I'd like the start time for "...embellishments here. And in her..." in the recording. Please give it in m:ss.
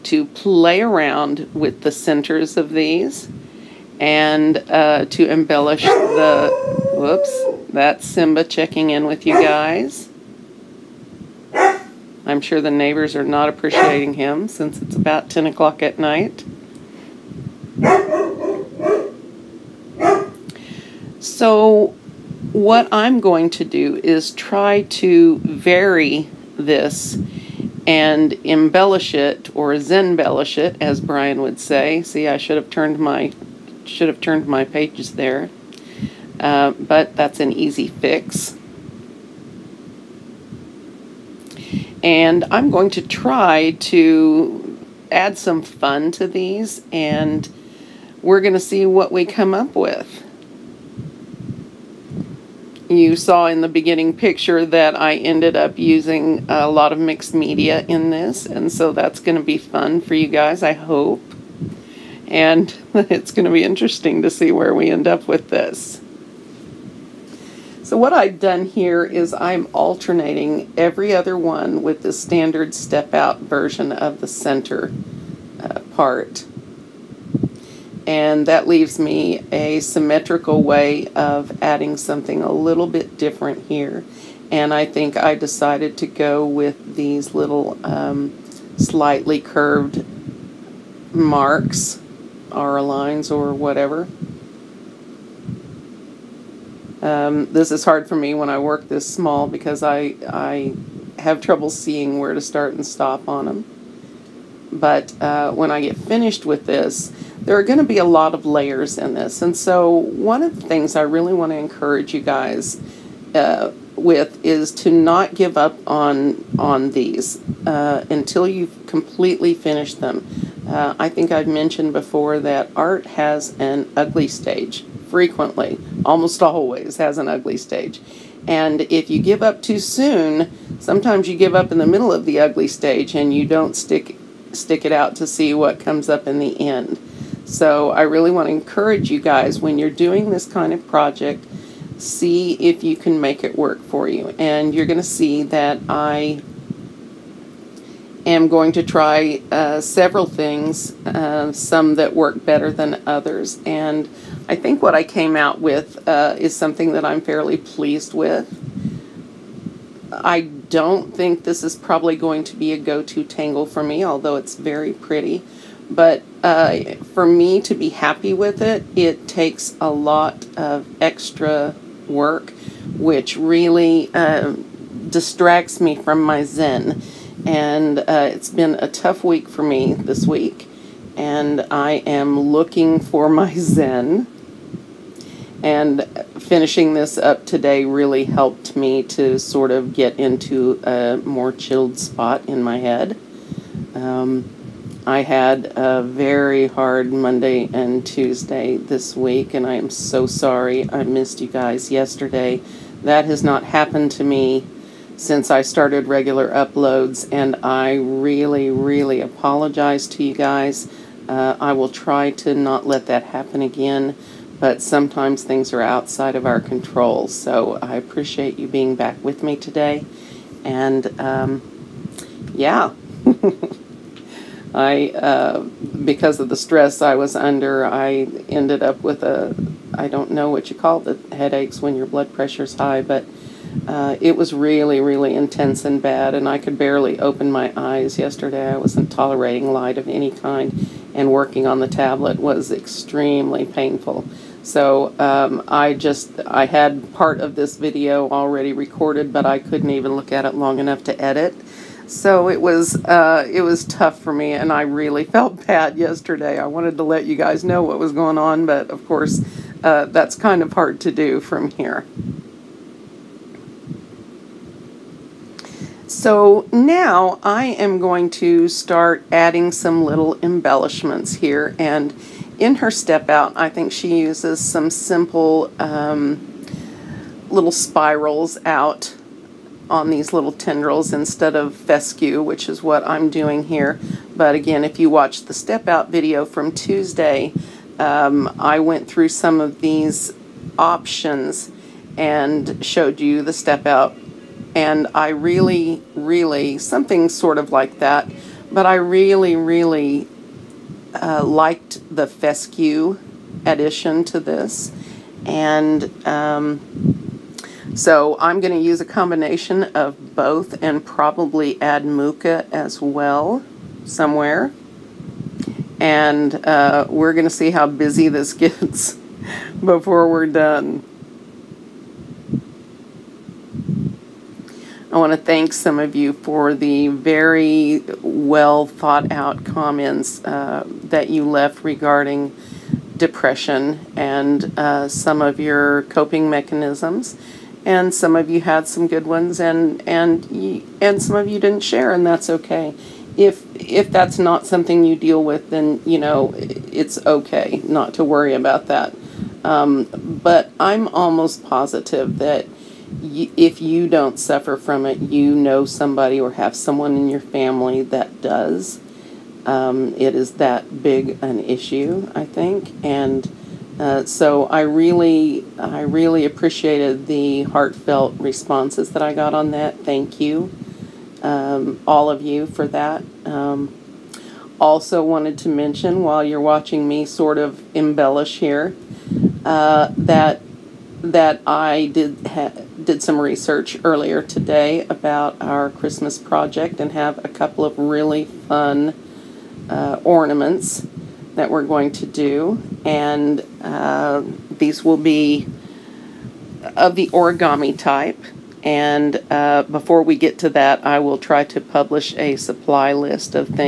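4:30.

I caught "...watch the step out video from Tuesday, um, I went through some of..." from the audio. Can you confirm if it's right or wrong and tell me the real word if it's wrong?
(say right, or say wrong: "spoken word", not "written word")
right.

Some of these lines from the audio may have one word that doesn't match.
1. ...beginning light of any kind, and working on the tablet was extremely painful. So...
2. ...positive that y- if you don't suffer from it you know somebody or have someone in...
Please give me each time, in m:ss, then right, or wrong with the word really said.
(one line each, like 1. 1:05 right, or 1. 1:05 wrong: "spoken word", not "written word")
1. 3:59 wrong: "tolerating", not "beginning"
2. 5:51 right.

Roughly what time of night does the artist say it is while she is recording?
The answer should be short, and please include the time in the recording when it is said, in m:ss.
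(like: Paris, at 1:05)
10 o'clock, at 0:15.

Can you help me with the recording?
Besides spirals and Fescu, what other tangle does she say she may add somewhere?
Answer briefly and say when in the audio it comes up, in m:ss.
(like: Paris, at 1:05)
Mooka, at 5:12.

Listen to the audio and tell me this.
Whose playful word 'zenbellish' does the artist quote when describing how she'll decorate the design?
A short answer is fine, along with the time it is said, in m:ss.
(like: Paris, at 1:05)
Brian, at 0:30.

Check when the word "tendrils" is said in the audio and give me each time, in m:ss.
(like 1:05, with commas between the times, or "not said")
4:40.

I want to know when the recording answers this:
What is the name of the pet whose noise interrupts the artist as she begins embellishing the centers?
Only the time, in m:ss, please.
0:08.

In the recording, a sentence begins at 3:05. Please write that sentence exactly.
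And finishing this up today really helped me to sort of get into a more chilled spot in my head.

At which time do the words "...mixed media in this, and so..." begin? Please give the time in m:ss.
0:56.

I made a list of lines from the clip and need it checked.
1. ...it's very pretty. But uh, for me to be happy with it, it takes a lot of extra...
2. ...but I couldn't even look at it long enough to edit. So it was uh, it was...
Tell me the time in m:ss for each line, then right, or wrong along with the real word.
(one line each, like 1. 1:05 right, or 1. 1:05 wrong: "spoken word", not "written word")
1. 2:44 right
2. 4:09 right.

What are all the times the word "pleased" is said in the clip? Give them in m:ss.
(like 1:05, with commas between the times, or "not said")
2:37.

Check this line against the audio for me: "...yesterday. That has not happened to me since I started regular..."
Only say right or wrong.
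right.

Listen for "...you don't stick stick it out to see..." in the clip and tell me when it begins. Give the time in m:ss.
2:13.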